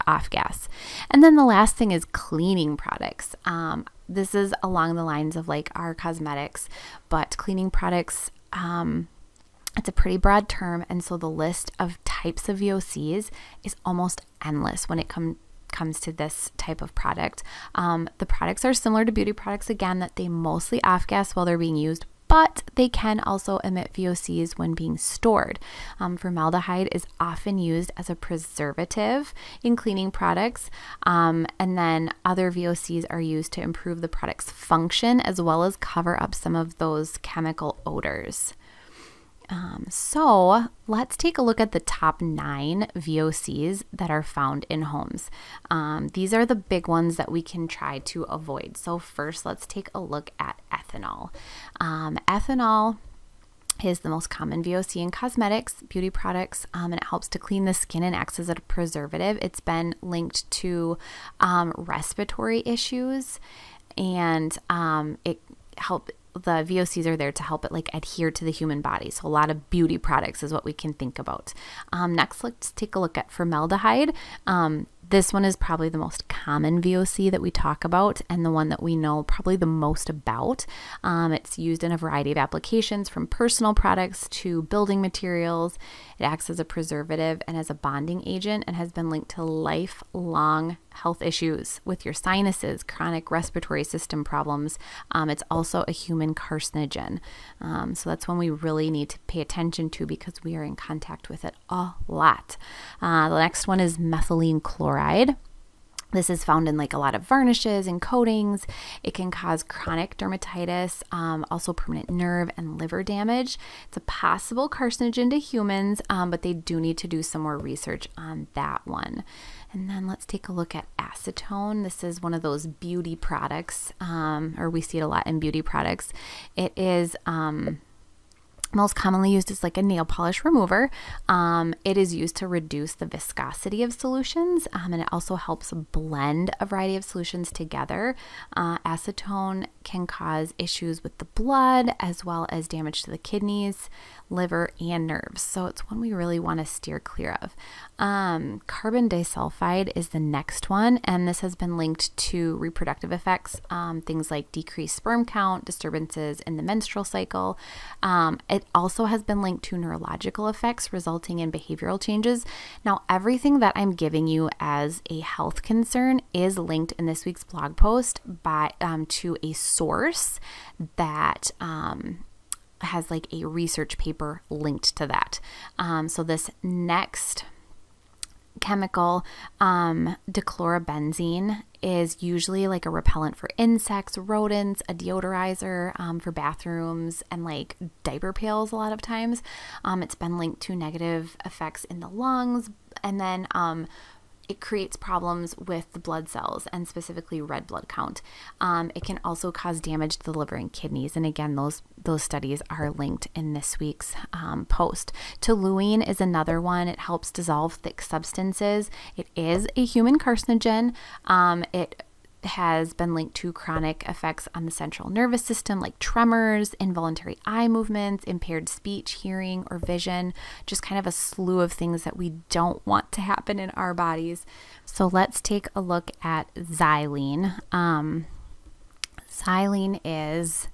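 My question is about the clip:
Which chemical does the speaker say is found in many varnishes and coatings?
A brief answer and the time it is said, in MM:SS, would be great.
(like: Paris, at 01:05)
Methylene chloride, at 01:43.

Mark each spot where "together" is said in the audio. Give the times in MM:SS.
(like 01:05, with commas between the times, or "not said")
02:17.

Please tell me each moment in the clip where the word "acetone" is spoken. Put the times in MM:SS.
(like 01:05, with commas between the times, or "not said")
02:00, 02:18.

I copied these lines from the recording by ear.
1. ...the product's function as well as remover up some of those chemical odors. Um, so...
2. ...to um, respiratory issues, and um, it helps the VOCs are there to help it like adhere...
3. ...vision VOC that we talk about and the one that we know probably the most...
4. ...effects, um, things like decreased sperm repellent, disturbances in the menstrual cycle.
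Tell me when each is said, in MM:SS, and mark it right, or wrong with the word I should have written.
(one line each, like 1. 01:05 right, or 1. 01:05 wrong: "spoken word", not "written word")
1. 00:34 wrong: "cover", not "remover"
2. 01:00 right
3. 01:16 wrong: "common", not "vision"
4. 02:33 wrong: "count", not "repellent".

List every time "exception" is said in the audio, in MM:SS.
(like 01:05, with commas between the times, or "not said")
not said.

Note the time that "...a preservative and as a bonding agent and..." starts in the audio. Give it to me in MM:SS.
01:26.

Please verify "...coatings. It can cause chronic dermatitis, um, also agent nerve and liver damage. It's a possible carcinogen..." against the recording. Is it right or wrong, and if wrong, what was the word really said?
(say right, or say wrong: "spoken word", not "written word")
wrong: "permanent", not "agent".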